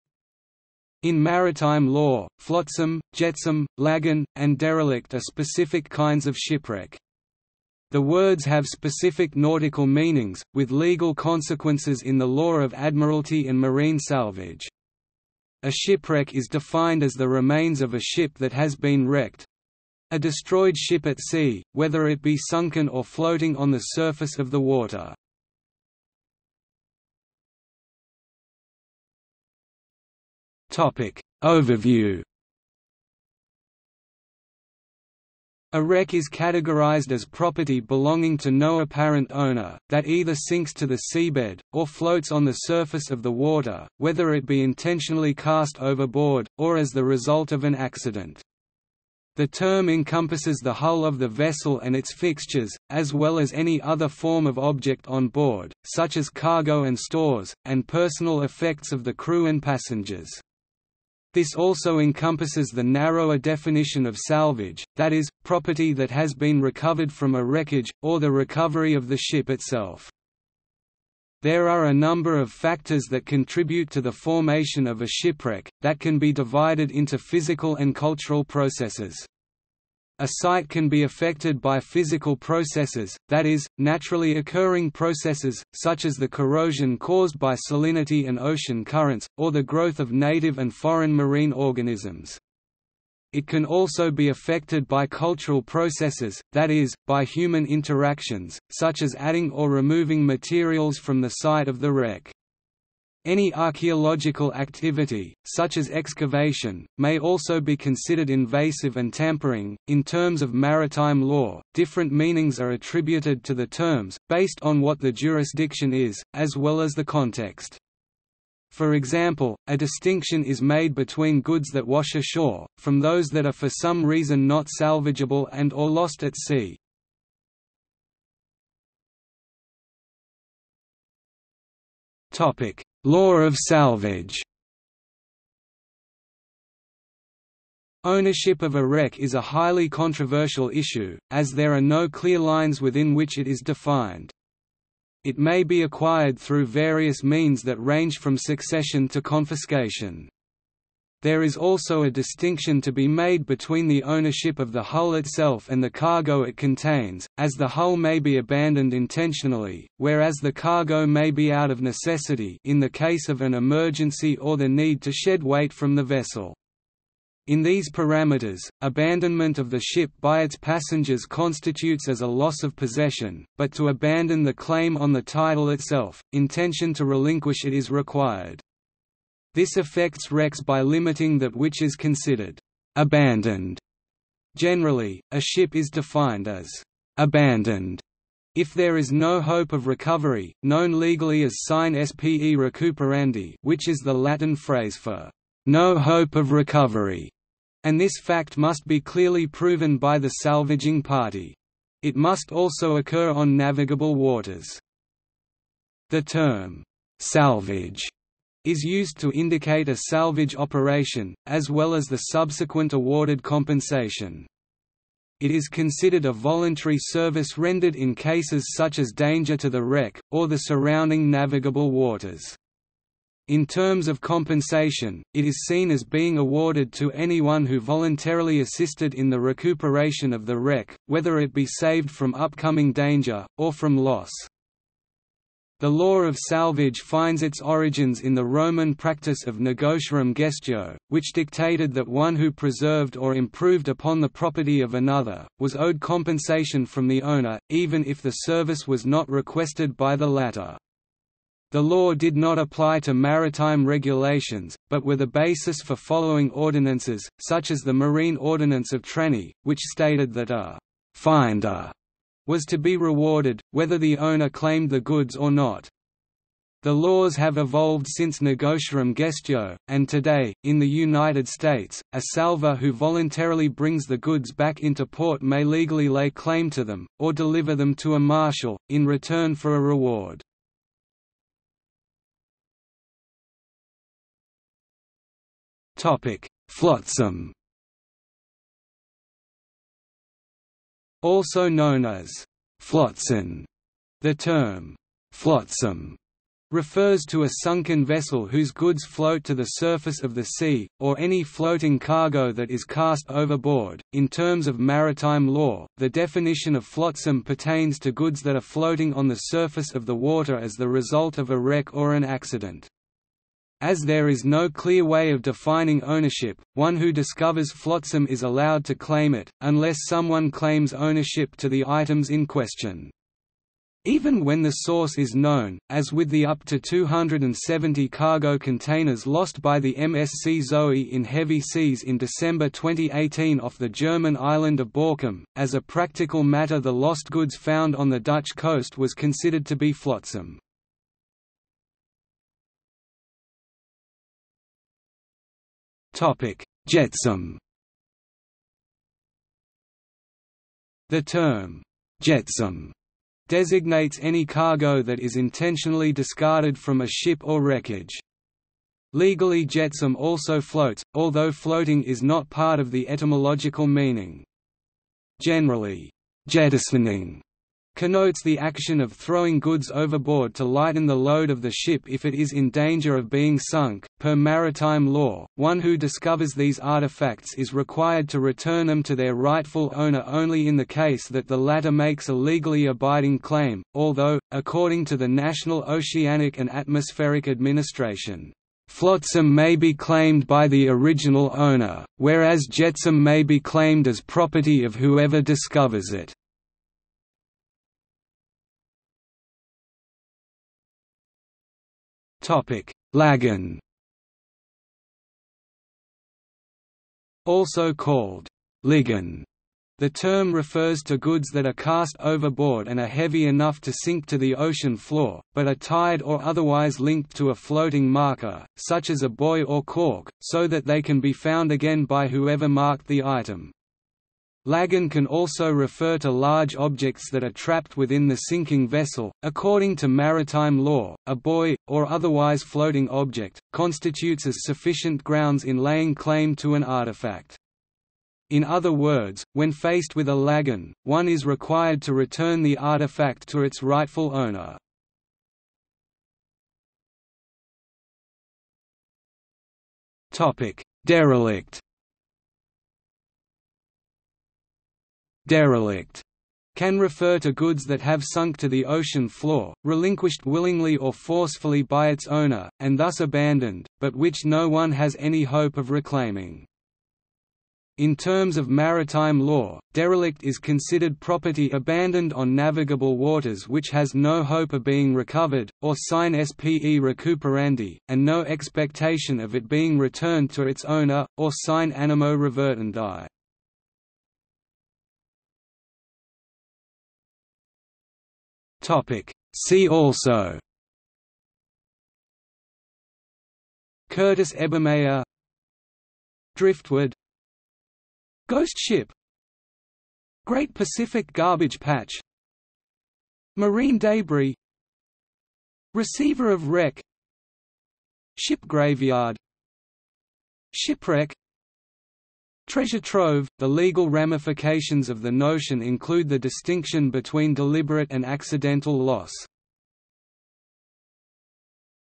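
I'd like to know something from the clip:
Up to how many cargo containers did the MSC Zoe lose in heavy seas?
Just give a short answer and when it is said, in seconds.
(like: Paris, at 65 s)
270, at 326 s.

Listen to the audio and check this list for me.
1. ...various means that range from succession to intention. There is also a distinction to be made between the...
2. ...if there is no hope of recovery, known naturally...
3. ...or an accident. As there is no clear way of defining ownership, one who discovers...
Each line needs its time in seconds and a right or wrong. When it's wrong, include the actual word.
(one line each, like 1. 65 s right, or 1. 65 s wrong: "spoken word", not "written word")
1. 146 s wrong: "confiscation", not "intention"
2. 188 s wrong: "legally", not "naturally"
3. 311 s right.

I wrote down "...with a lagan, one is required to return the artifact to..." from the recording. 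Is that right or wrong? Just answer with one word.
right.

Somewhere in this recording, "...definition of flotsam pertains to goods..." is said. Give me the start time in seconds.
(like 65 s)
306 s.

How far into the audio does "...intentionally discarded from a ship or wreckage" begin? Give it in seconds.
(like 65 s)
355 s.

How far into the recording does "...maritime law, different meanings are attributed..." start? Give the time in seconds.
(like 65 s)
110 s.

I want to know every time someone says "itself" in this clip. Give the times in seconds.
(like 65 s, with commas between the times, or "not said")
69 s, 155 s, 175 s.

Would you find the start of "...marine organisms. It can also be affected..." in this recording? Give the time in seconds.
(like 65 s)
91 s.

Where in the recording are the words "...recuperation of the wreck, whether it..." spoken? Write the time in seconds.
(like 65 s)
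229 s.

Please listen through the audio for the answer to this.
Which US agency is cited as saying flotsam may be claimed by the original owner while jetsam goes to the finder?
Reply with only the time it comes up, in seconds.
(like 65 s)
385 s.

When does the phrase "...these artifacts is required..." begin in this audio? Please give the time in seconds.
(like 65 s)
376 s.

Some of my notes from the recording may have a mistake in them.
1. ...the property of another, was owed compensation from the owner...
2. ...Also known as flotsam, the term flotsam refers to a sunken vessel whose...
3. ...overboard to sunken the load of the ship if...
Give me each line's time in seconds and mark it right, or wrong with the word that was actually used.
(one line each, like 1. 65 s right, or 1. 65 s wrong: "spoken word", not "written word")
1. 244 s right
2. 291 s right
3. 369 s wrong: "lighten", not "sunken".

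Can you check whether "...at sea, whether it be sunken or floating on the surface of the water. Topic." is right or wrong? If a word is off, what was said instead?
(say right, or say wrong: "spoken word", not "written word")
right.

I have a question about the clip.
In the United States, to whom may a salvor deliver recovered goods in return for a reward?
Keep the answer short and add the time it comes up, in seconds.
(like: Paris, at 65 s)
a marshal, at 278 s.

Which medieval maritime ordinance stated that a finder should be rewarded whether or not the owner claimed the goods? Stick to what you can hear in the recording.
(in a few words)
Marine Ordinance of Trani.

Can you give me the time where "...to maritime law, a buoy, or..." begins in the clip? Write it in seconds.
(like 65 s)
429 s.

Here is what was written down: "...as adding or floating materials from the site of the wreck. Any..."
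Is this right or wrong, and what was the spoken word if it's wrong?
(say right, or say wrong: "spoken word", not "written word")
wrong: "removing", not "floating".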